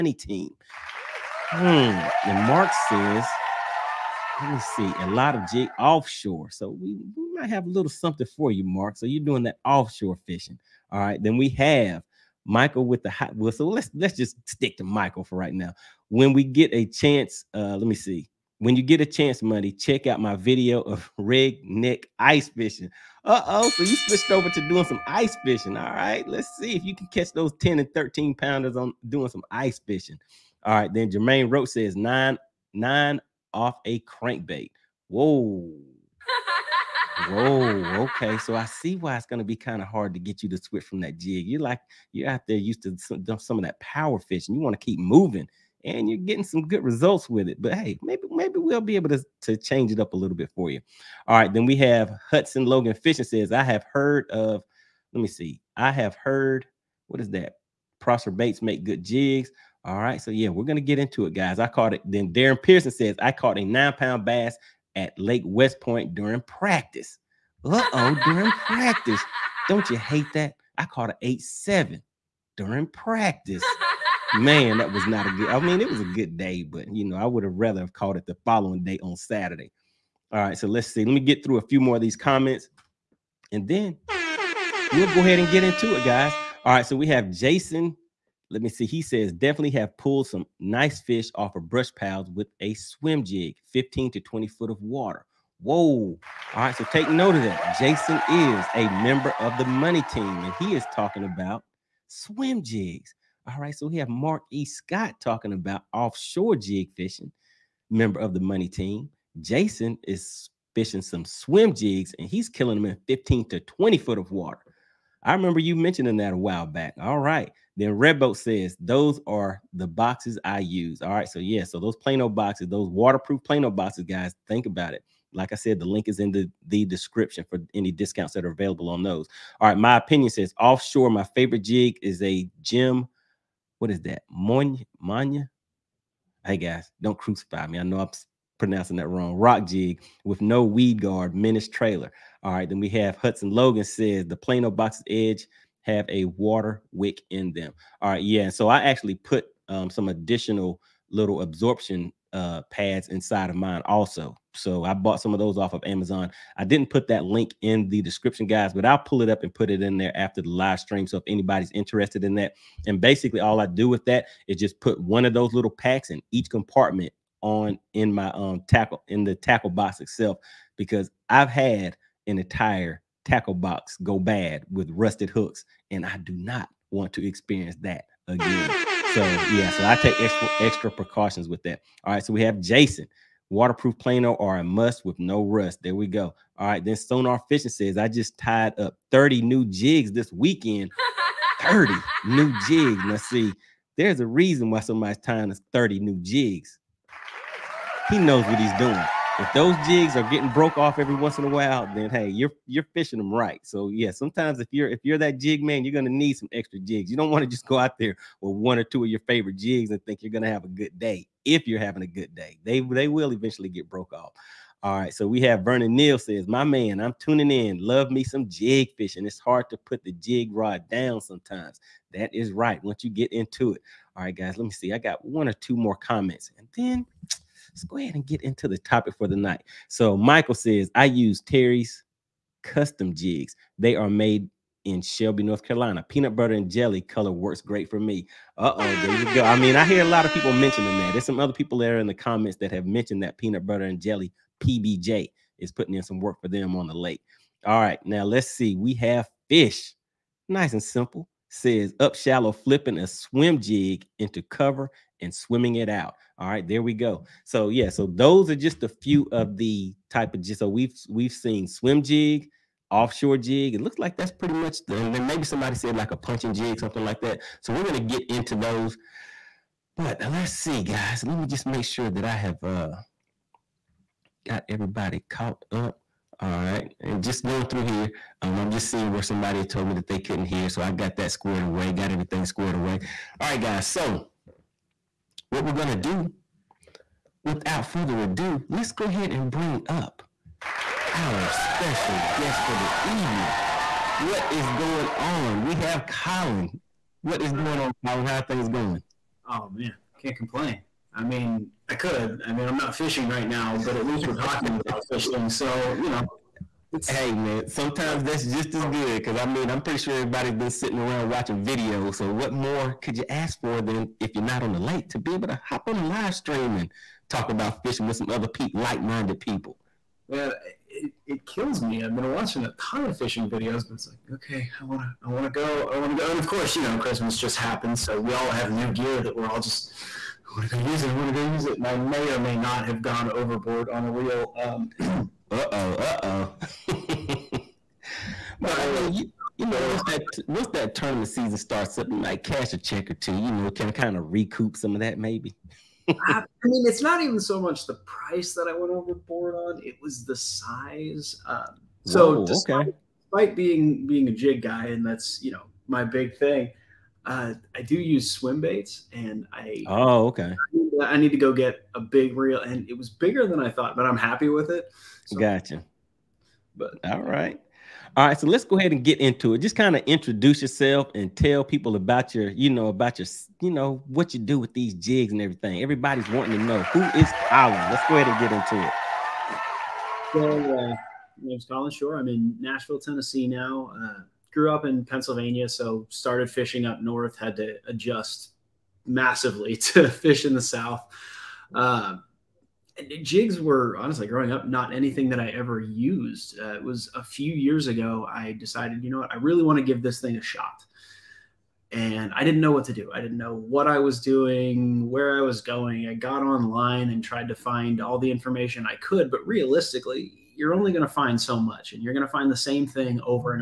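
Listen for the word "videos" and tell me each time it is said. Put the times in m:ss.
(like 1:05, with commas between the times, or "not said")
0:20, 5:11, 5:23.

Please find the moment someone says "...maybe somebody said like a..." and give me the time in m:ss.
4:25.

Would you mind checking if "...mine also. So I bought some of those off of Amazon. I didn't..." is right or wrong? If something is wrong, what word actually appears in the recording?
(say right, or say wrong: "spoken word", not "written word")
right.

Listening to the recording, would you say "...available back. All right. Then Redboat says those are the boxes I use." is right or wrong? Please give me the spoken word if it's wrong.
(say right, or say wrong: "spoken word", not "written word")
wrong: "while", not "available".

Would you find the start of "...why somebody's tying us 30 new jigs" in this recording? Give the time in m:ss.
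3:14.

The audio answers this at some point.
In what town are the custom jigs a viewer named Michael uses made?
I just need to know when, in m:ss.
3:54.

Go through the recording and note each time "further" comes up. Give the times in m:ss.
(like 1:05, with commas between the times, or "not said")
4:47.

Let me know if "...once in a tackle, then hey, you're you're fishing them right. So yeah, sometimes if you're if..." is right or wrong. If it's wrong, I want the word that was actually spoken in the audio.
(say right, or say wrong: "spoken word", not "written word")
wrong: "while", not "tackle".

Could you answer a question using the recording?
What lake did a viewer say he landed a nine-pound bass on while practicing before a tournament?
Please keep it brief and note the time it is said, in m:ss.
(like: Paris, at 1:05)
Lake West Point, at 1:05.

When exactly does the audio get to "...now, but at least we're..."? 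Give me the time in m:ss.
5:03.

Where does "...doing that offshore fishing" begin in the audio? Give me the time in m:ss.
0:09.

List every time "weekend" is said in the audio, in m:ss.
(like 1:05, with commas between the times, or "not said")
3:10.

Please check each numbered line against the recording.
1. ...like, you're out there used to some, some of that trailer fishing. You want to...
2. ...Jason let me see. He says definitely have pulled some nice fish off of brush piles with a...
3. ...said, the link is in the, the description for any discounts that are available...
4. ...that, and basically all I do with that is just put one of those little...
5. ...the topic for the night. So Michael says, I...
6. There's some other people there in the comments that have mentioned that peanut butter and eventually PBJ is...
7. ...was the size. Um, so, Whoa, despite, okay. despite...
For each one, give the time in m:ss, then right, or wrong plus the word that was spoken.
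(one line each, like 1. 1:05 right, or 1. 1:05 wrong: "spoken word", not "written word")
1. 0:41 wrong: "power", not "trailer"
2. 1:27 right
3. 2:05 right
4. 2:42 right
5. 3:48 right
6. 4:01 wrong: "jelly", not "eventually"
7. 5:50 right.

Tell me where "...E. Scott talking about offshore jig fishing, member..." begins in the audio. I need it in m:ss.
1:44.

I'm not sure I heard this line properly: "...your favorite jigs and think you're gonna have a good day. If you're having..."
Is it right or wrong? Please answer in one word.
right.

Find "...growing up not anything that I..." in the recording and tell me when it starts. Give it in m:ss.
6:34.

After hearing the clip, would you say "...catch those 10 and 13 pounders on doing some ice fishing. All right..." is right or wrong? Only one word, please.
right.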